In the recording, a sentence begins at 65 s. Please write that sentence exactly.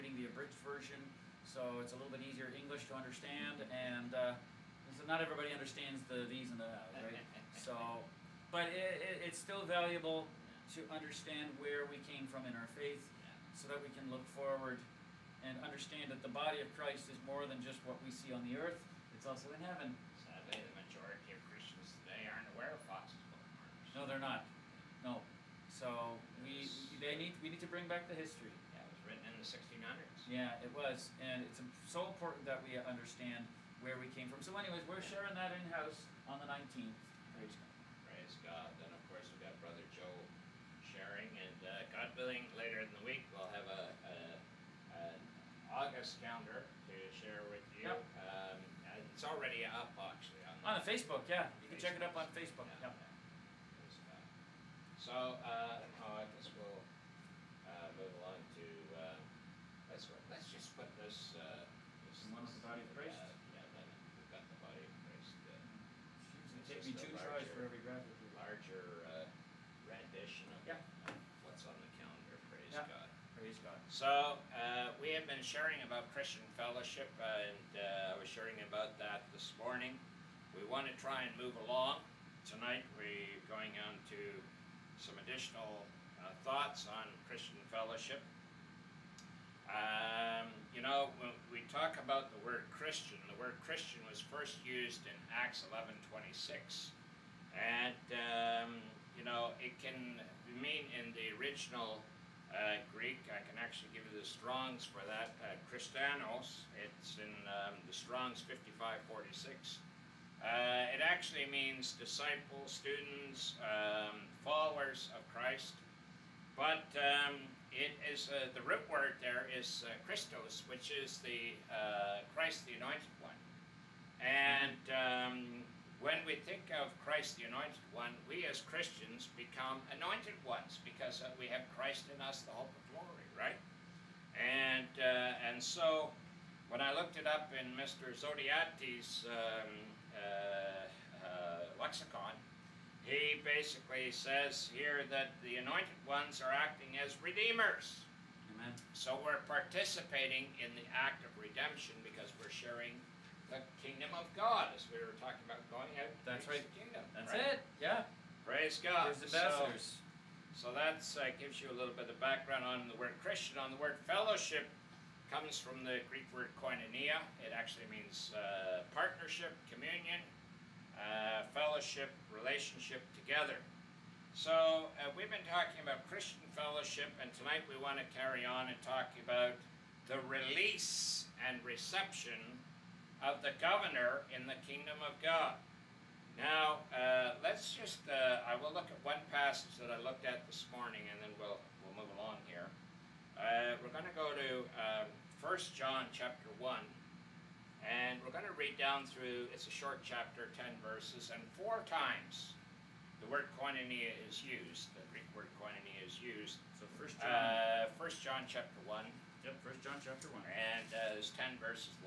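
Uh, to take me two larger, tries for every graphic.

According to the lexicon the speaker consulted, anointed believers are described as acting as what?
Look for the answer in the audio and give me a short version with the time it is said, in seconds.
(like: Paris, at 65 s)
Redeemers, at 147 s.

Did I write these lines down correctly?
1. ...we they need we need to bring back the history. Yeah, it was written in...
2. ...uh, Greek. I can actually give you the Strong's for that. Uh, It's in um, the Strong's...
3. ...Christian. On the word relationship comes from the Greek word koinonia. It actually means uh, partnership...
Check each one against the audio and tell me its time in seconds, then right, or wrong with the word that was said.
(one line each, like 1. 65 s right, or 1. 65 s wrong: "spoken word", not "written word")
1. 26 s right
2. 102 s right
3. 163 s wrong: "fellowship", not "relationship".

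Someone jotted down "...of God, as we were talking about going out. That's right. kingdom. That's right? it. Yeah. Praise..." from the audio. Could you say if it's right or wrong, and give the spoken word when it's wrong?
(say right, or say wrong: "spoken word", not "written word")
right.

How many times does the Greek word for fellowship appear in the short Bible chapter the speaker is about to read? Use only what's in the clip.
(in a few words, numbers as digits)
4.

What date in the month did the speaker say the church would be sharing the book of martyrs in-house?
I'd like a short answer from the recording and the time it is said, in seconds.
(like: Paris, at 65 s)
19th, at 36 s.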